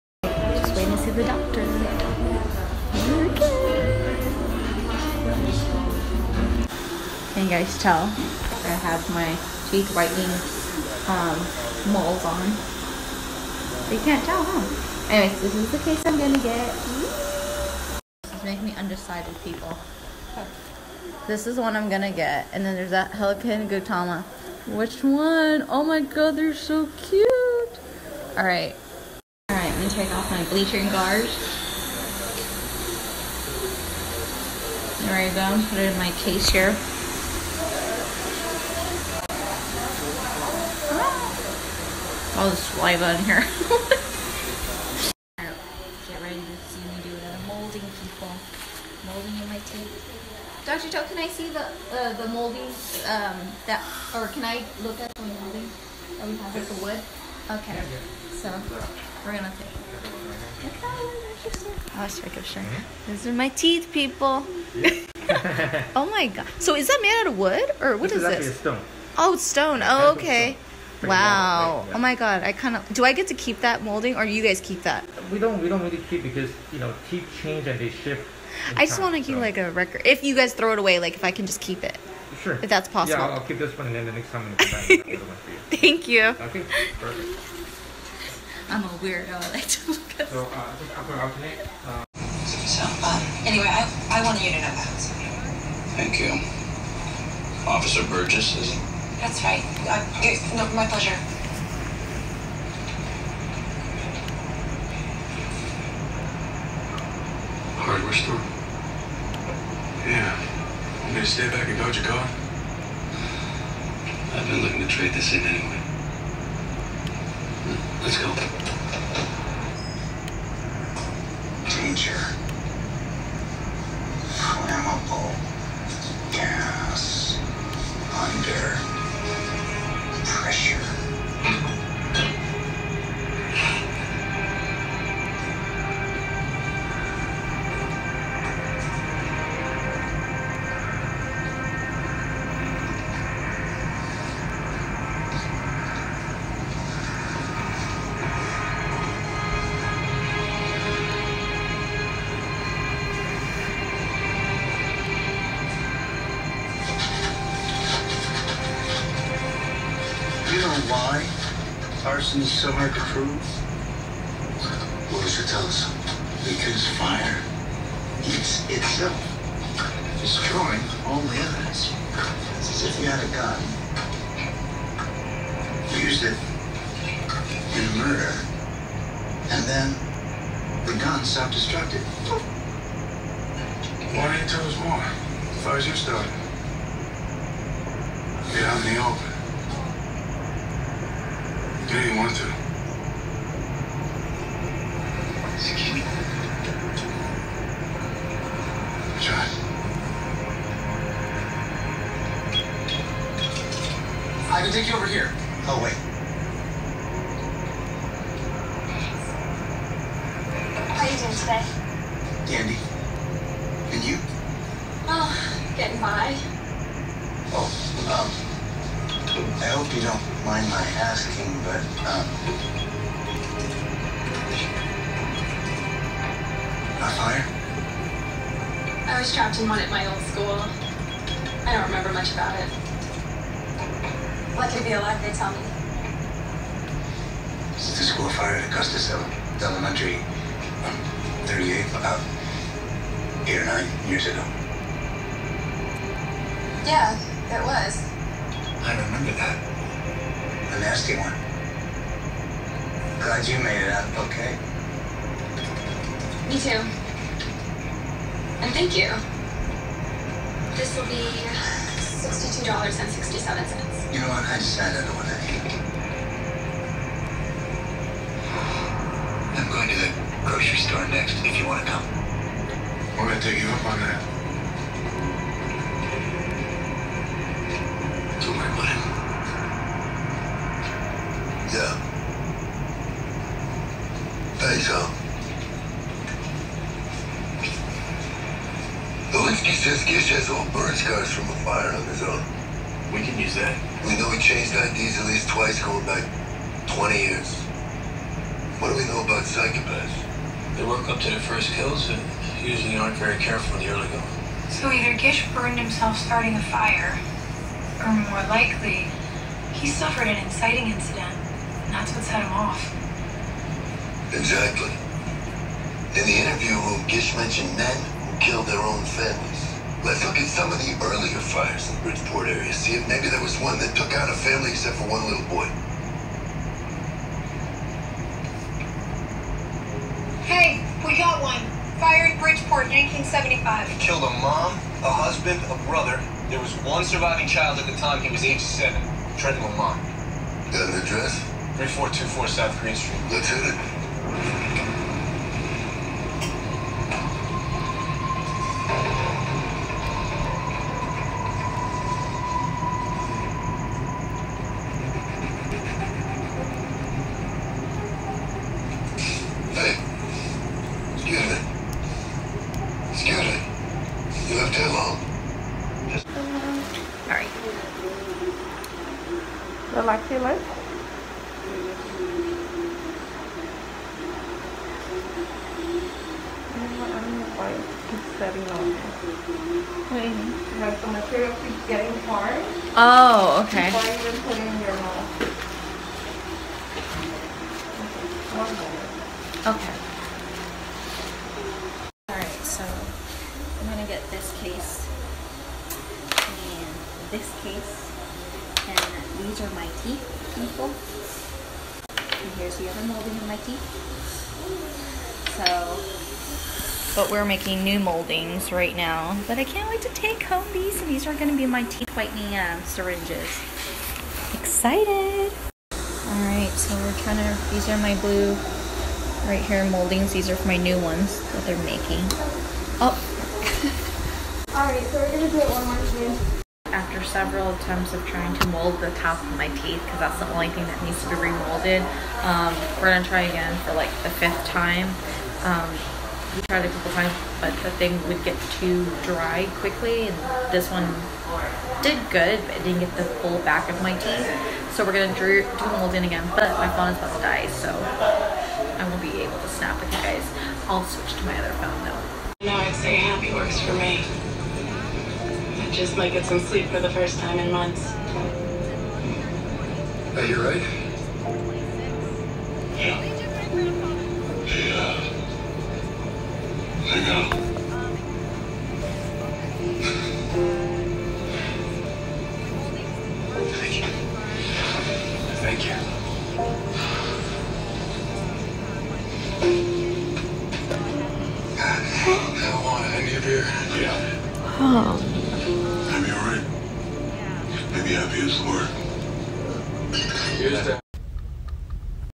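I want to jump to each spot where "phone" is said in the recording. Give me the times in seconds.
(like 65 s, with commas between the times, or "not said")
446 s, 451 s.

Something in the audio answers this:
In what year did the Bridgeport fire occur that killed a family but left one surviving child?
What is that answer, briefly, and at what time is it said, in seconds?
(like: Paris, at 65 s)
1975, at 332 s.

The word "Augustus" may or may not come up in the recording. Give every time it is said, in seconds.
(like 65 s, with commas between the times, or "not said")
238 s.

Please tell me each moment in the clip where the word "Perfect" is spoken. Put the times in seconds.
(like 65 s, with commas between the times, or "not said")
86 s.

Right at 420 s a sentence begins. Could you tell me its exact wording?
These are for my new ones that they're making.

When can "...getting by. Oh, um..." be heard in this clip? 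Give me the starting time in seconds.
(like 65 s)
215 s.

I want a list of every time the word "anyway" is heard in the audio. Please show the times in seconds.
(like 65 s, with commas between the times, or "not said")
15 s, 93 s, 115 s.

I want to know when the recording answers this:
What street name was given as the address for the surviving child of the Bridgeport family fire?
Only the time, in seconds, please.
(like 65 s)
342 s.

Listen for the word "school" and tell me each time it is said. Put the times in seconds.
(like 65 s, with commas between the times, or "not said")
230 s, 238 s.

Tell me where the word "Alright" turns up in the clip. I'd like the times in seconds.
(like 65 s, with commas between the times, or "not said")
415 s, 424 s.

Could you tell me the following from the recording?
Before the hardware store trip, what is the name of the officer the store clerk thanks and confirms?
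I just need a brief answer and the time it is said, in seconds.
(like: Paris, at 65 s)
Officer Burgess, at 97 s.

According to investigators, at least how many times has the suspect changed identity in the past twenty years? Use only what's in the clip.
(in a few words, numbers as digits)
2.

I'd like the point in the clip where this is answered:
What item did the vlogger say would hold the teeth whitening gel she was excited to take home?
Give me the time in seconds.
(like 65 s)
412 s.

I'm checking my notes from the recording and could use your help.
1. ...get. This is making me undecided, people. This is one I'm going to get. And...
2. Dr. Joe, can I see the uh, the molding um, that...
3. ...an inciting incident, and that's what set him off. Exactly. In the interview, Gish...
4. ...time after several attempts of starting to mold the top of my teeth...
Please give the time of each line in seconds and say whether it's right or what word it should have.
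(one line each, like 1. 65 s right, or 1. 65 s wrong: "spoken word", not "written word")
1. 16 s right
2. 50 s right
3. 310 s right
4. 426 s wrong: "trying", not "starting".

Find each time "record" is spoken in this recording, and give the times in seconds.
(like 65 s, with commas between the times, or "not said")
79 s.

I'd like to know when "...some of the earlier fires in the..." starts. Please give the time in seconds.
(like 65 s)
320 s.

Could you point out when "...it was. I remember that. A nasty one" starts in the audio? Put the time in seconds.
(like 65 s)
247 s.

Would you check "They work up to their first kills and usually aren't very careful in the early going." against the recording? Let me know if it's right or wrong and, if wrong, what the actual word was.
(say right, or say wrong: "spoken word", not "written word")
right.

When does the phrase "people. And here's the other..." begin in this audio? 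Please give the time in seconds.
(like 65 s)
400 s.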